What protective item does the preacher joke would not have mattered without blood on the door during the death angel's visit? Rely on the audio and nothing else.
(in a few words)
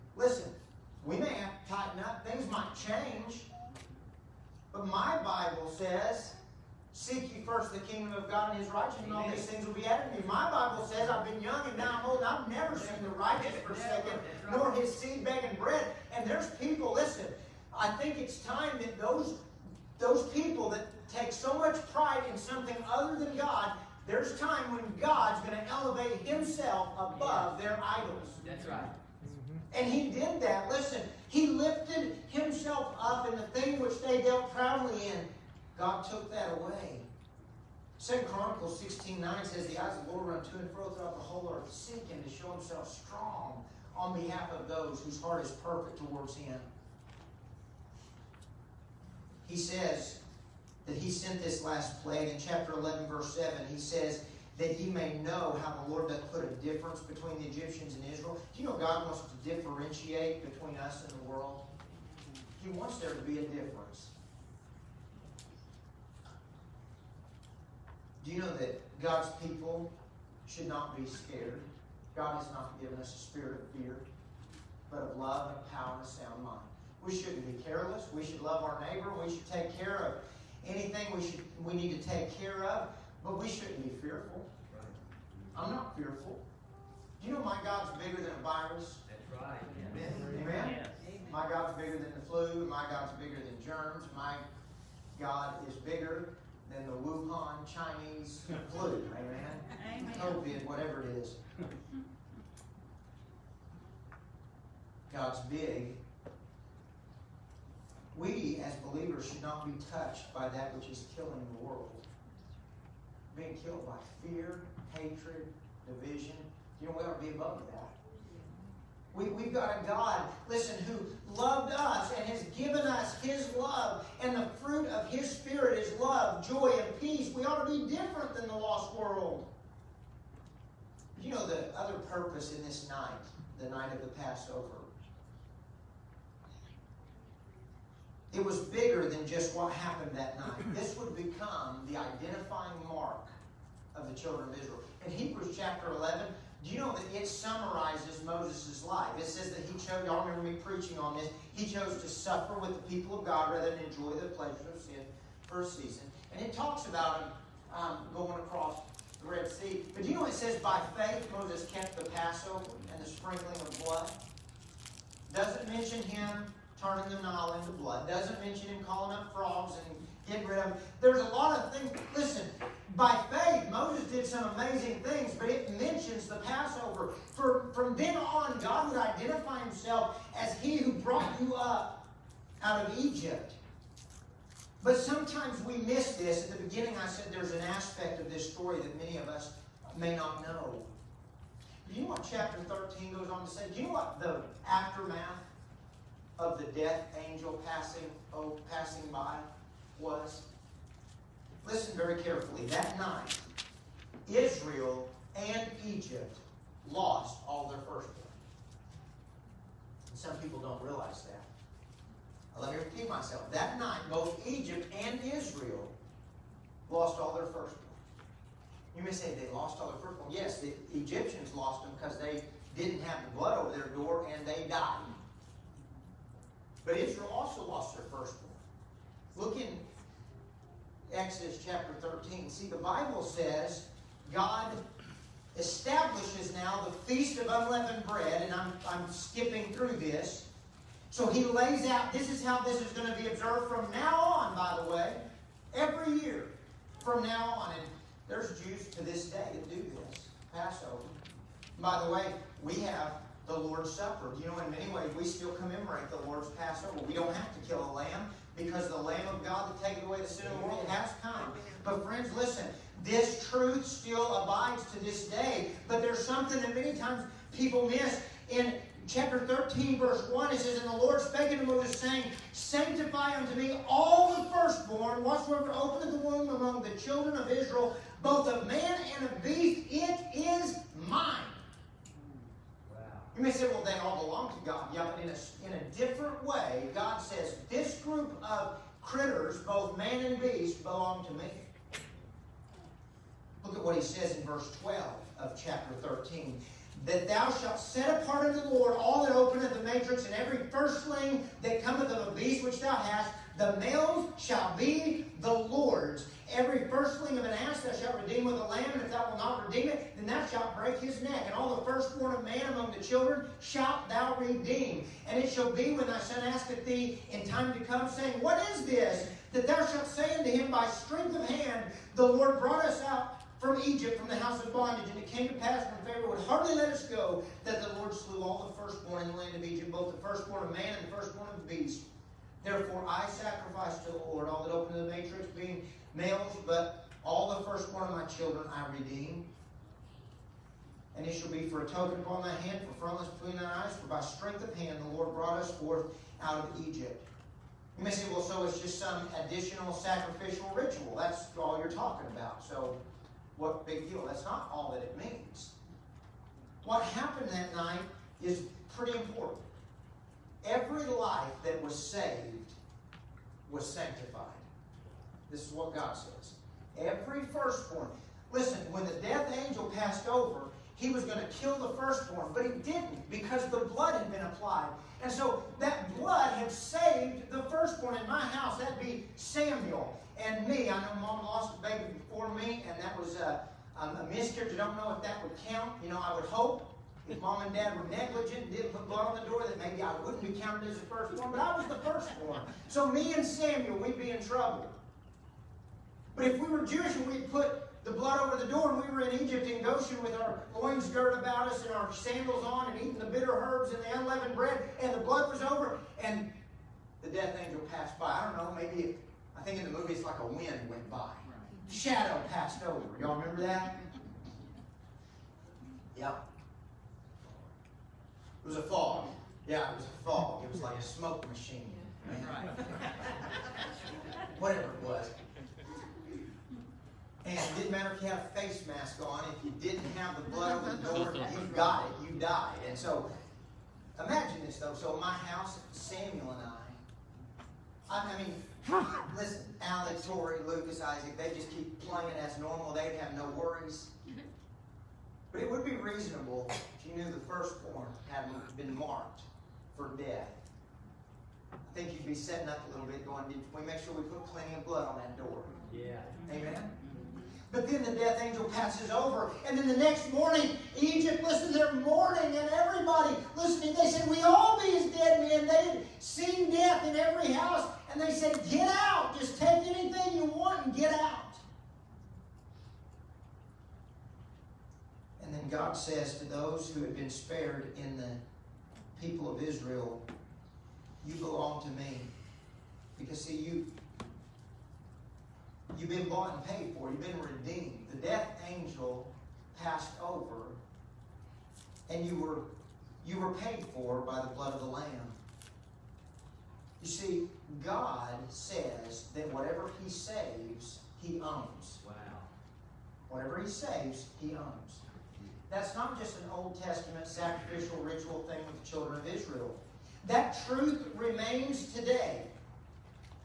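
A face mask.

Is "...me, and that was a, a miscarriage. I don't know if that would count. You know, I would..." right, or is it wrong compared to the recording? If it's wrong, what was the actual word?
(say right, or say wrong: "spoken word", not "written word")
right.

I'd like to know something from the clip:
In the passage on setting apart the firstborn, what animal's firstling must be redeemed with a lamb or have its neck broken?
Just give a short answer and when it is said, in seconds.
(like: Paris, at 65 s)
An ass, at 307 s.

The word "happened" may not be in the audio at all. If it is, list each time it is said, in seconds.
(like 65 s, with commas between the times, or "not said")
139 s, 357 s.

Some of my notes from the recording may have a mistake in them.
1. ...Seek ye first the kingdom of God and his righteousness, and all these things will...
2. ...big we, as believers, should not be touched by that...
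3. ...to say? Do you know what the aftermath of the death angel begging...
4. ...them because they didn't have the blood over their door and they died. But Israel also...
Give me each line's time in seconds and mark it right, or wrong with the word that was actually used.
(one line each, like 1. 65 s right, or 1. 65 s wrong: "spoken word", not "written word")
1. 6 s right
2. 105 s right
3. 193 s wrong: "passing", not "begging"
4. 221 s right.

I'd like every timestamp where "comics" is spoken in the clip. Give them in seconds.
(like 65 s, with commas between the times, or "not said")
not said.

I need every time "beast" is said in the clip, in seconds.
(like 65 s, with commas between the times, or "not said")
279 s, 290 s, 302 s, 331 s.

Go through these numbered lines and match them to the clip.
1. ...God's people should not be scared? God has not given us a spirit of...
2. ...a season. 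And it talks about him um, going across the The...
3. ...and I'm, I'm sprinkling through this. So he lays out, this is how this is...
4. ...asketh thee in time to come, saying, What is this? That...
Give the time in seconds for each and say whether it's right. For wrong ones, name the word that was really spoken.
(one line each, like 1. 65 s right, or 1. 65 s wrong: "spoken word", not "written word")
1. 69 s right
2. 155 s wrong: "Red", not "The"
3. 238 s wrong: "skipping", not "sprinkling"
4. 316 s right.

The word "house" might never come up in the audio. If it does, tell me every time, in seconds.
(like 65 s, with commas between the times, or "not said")
324 s, 378 s, 435 s, 467 s.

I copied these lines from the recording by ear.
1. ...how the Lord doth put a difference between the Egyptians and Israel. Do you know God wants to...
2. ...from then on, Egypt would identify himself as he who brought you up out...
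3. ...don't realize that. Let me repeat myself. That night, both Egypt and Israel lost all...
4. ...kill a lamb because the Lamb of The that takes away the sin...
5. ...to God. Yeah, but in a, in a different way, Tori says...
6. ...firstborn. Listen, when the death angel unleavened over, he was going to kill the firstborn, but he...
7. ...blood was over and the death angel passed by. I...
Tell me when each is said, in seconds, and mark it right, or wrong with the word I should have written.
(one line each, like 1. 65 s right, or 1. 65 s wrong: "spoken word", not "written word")
1. 55 s right
2. 177 s wrong: "God", not "Egypt"
3. 210 s right
4. 257 s wrong: "God", not "The"
5. 284 s wrong: "God", not "Tori"
6. 367 s wrong: "passed", not "unleavened"
7. 405 s right.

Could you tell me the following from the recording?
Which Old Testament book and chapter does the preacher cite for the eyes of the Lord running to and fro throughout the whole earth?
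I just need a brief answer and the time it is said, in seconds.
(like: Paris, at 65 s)
Second Chronicles 16, at 37 s.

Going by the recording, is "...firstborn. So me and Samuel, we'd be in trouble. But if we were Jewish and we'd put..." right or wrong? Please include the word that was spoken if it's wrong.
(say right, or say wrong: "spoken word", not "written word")
right.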